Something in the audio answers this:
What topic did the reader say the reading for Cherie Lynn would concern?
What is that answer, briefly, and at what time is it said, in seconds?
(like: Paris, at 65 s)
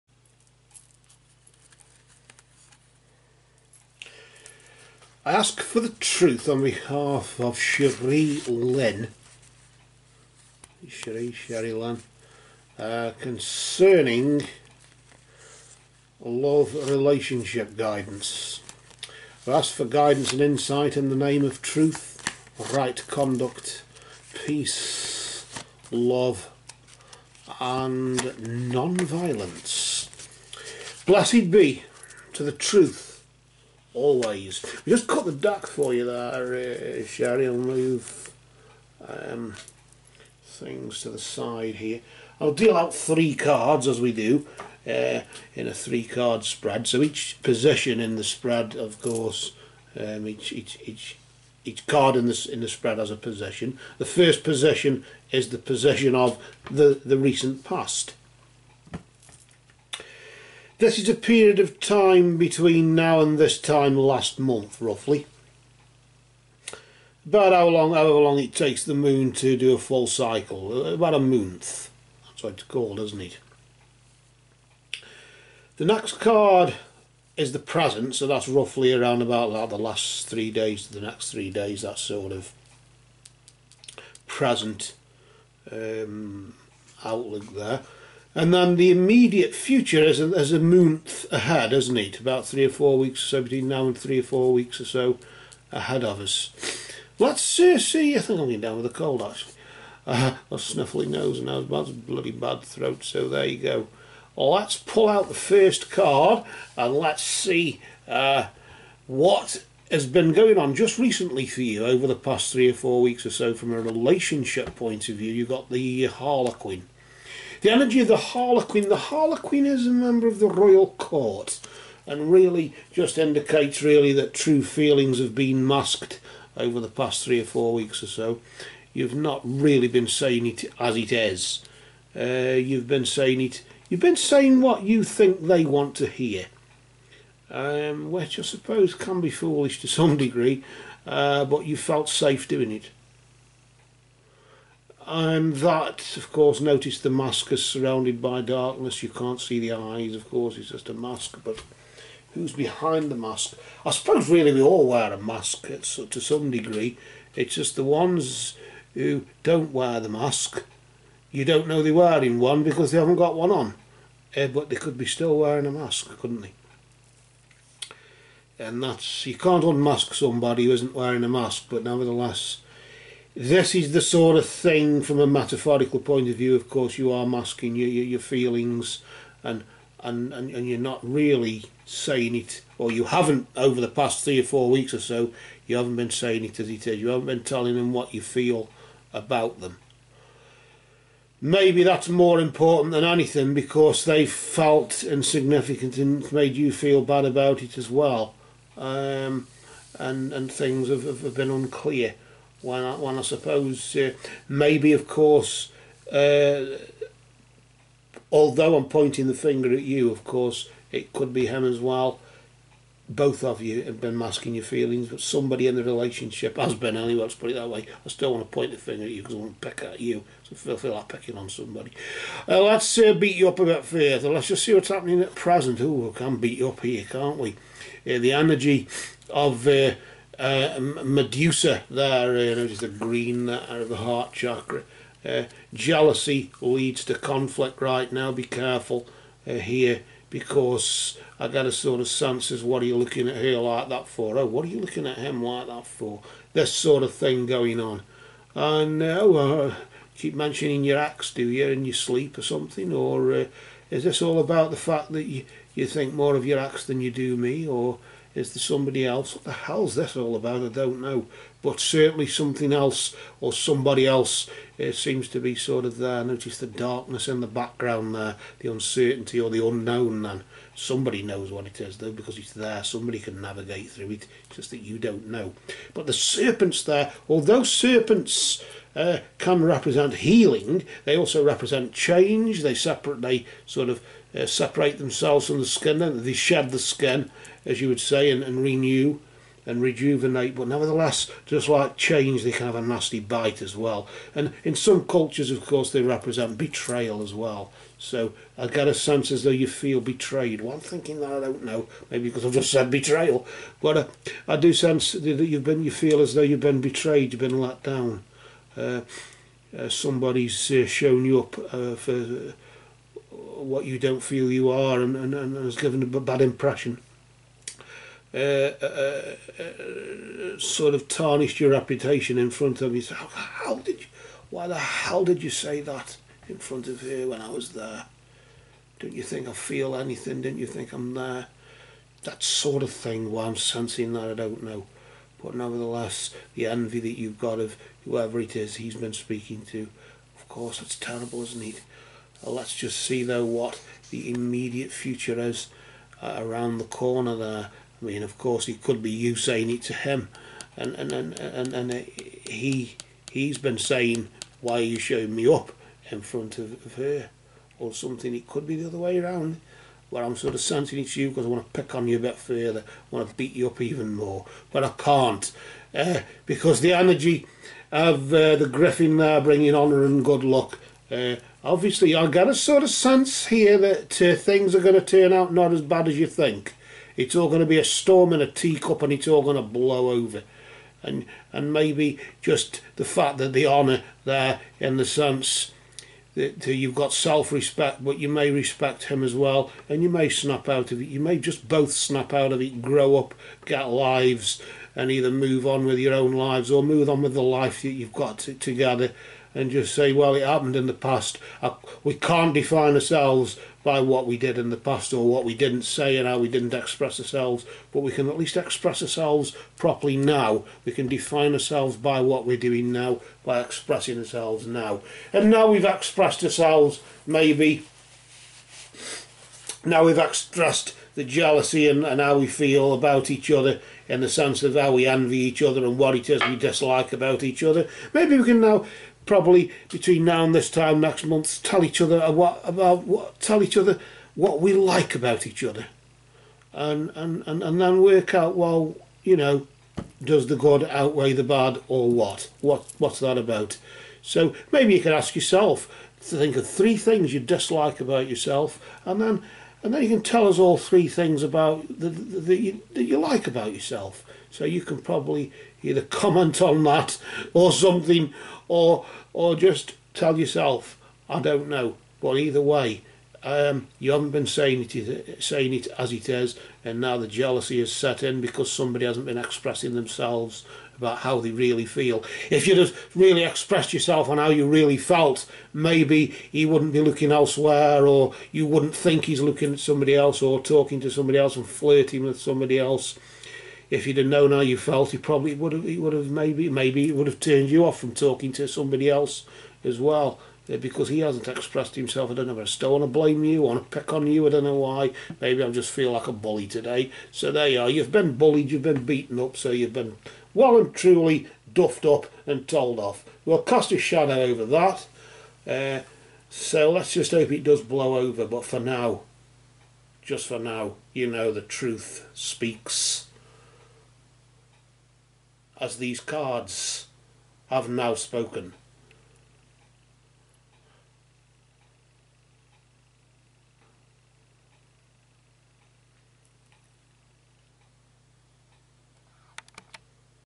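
Love relationship guidance, at 16 s.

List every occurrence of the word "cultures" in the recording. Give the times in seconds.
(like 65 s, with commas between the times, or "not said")
295 s.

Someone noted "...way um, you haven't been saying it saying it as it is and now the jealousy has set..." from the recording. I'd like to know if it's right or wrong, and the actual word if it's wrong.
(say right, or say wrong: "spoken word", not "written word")
right.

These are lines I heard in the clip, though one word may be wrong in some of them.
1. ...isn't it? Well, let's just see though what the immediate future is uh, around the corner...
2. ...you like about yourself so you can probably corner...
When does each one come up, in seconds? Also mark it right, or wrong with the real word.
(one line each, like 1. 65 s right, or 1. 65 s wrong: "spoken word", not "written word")
1. 341 s right
2. 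453 s wrong: "either", not "corner".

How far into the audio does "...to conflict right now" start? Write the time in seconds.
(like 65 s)
237 s.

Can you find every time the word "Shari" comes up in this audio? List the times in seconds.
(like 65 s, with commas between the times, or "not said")
11 s, 37 s.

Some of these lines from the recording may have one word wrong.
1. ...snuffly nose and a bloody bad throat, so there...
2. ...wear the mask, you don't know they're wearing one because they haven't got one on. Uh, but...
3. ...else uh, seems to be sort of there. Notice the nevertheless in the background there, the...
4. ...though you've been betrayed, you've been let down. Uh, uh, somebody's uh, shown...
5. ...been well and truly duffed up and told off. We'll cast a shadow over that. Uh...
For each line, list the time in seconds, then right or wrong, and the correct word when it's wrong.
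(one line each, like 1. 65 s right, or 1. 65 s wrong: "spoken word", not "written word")
1. 100 s right
2. 159 s right
3. 264 s wrong: "darkness", not "nevertheless"
4. 306 s right
5. 499 s right.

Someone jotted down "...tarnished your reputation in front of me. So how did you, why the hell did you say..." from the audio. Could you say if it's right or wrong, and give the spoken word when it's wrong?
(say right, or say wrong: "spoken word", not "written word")
right.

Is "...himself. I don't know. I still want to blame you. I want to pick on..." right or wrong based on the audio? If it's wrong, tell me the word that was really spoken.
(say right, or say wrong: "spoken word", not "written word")
right.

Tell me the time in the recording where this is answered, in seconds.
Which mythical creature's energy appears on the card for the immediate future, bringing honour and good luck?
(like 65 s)
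368 s.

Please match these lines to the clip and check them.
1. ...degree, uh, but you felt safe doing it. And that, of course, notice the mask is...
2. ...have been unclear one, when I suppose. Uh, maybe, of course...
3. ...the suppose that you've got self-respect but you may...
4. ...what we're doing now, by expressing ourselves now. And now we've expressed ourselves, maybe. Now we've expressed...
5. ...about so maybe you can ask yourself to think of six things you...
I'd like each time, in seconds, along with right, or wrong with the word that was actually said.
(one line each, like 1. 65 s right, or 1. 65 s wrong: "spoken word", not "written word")
1. 140 s right
2. 201 s right
3. 384 s wrong: "sense", not "suppose"
4. 412 s right
5. 443 s wrong: "three", not "six".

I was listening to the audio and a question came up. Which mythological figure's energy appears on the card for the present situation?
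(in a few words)
Medusa.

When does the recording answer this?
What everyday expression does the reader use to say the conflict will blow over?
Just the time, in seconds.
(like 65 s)
377 s.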